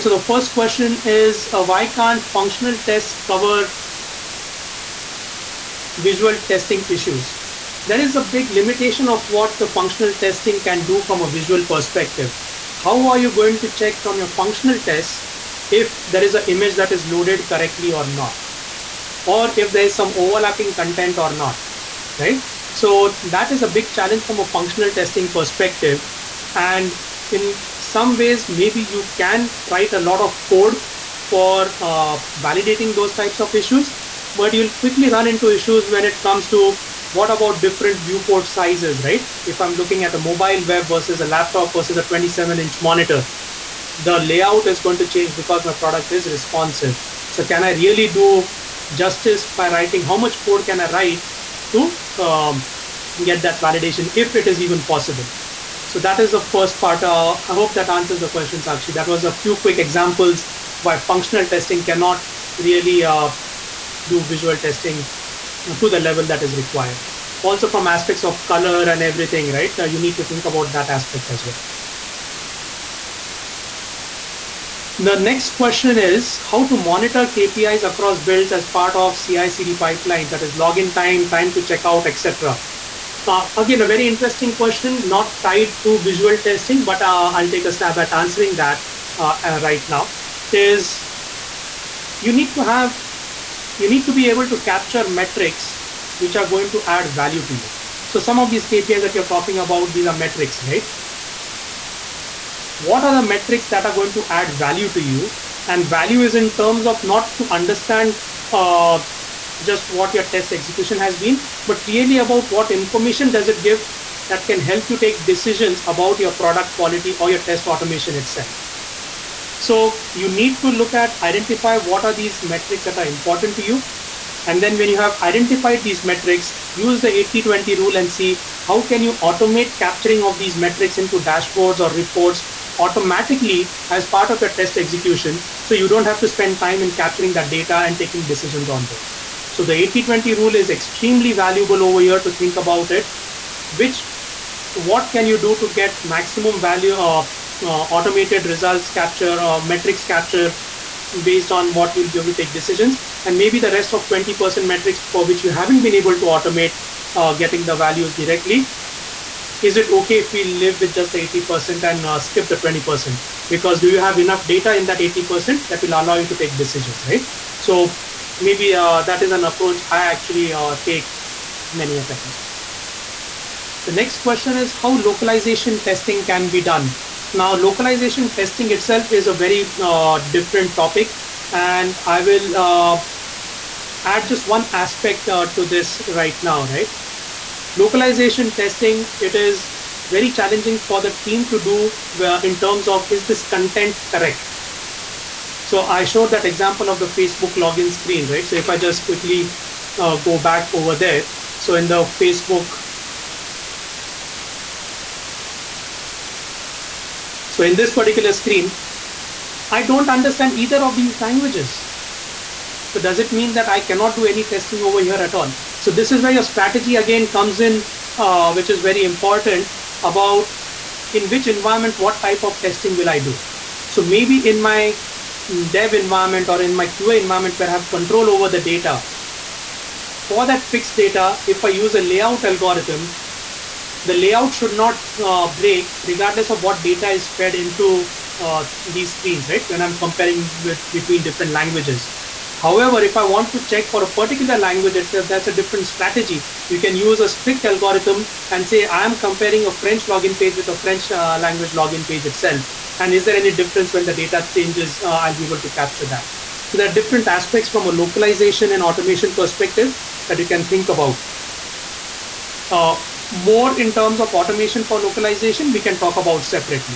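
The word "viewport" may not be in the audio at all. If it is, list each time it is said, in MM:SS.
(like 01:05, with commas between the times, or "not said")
00:38.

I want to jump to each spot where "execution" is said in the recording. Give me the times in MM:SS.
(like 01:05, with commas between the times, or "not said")
01:50, 02:14.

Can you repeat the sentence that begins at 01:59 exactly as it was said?
So you need to look at identify what are these metrics that are important to you.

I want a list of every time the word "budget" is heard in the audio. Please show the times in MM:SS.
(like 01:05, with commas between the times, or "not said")
not said.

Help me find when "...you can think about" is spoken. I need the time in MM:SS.
04:20.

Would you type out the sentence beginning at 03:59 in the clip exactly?
When I'm comparing with, between different languages.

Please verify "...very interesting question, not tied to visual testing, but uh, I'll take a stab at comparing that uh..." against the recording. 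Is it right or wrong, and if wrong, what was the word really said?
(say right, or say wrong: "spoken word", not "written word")
wrong: "answering", not "comparing".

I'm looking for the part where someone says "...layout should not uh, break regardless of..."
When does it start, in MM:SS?
03:54.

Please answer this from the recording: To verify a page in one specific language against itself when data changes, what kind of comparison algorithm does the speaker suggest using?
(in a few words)
strict algorithm.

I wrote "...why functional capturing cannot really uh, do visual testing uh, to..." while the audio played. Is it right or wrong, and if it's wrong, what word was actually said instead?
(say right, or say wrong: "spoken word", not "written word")
wrong: "testing", not "capturing".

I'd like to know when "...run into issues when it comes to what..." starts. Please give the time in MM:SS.
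00:35.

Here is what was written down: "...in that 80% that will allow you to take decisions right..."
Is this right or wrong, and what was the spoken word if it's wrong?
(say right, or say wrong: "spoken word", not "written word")
right.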